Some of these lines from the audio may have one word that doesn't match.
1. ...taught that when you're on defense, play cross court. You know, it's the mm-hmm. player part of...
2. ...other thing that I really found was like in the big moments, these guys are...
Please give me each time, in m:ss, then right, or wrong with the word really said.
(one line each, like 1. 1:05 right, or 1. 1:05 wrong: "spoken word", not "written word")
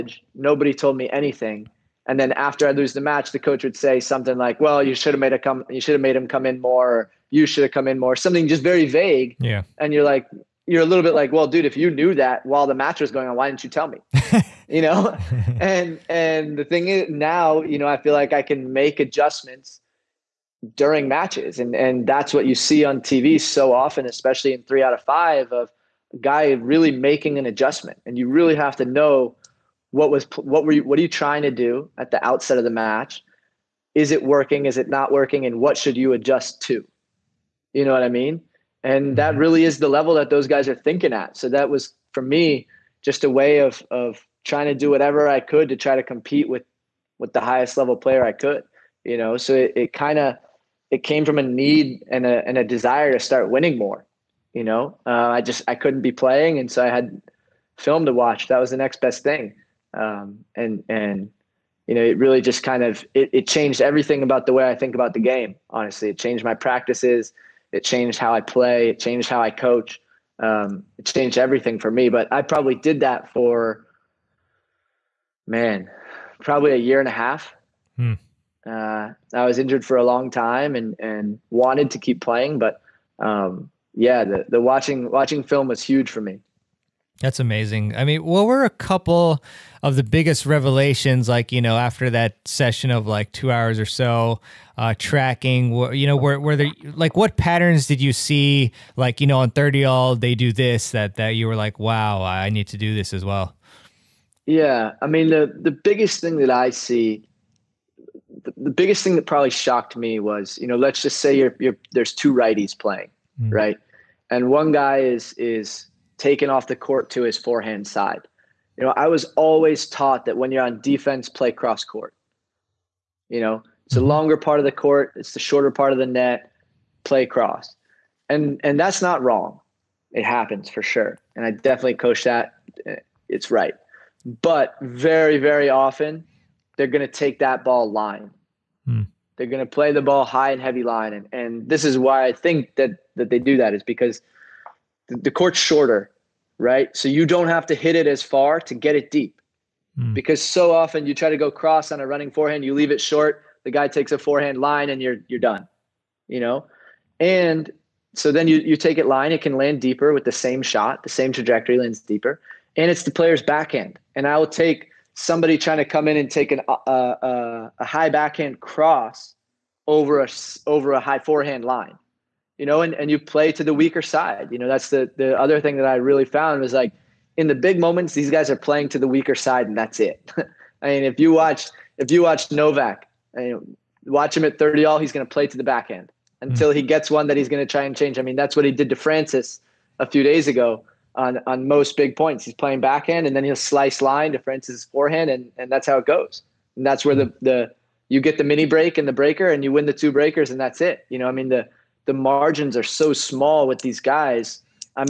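1. 1:59 wrong: "longer", not "player"
2. 2:55 right.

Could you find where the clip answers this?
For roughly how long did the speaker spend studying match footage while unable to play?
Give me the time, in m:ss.
1:16.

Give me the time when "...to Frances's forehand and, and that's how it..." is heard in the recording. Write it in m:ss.
3:14.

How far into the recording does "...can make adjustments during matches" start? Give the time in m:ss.
0:18.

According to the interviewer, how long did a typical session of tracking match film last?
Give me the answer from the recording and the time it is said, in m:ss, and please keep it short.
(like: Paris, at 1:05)
2 hours, at 1:33.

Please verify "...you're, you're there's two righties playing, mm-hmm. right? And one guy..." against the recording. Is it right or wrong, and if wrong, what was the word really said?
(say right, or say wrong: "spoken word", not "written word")
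right.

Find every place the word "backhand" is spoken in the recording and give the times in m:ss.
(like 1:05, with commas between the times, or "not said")
2:43, 2:48, 3:05, 3:12.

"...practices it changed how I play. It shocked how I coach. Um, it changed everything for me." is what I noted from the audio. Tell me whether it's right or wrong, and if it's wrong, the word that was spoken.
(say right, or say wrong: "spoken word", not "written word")
wrong: "changed", not "shocked".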